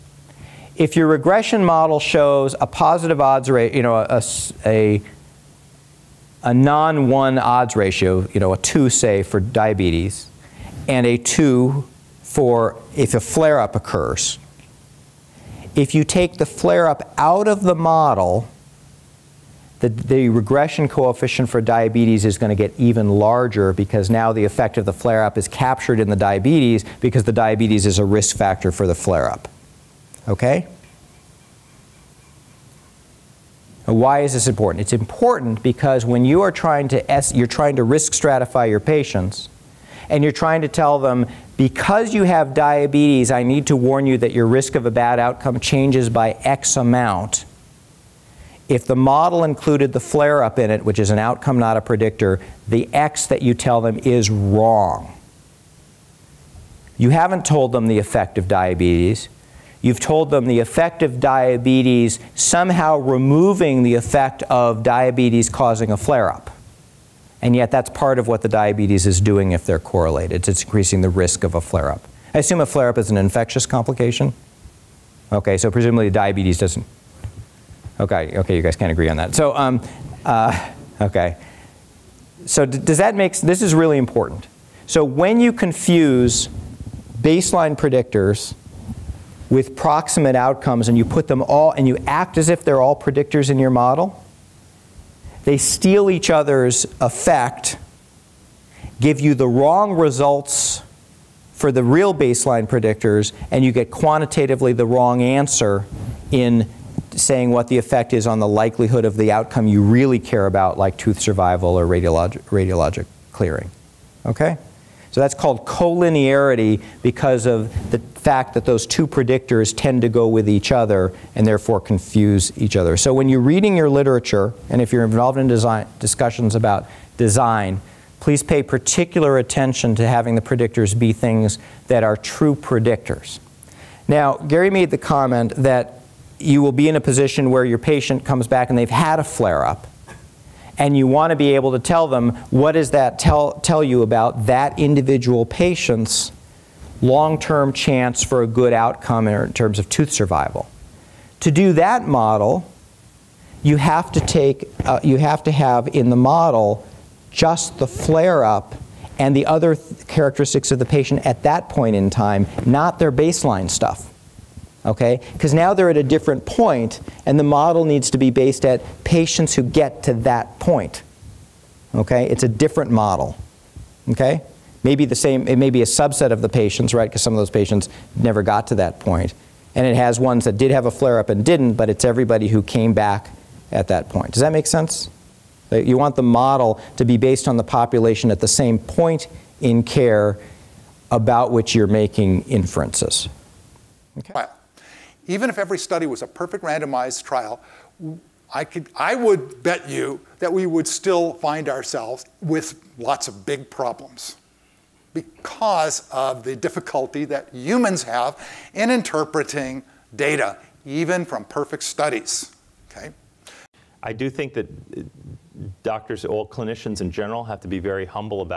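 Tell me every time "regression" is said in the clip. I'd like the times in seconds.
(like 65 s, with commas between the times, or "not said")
1 s, 20 s.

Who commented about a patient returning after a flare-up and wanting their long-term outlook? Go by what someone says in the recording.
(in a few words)
Gary.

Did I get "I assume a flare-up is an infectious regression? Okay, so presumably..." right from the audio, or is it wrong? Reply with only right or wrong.
wrong.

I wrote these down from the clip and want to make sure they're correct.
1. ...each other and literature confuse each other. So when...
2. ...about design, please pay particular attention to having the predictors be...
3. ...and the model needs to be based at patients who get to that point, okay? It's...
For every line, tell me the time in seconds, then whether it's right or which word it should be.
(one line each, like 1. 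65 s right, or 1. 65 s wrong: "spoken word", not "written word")
1. 120 s wrong: "therefore", not "literature"
2. 126 s right
3. 167 s right.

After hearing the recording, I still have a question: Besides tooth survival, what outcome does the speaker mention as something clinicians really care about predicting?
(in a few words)
Radiologic clearing.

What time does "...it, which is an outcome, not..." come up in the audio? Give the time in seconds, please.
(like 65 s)
50 s.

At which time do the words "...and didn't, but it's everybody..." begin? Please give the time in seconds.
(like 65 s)
181 s.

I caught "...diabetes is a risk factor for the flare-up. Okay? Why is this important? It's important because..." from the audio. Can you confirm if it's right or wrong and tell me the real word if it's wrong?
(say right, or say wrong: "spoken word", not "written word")
right.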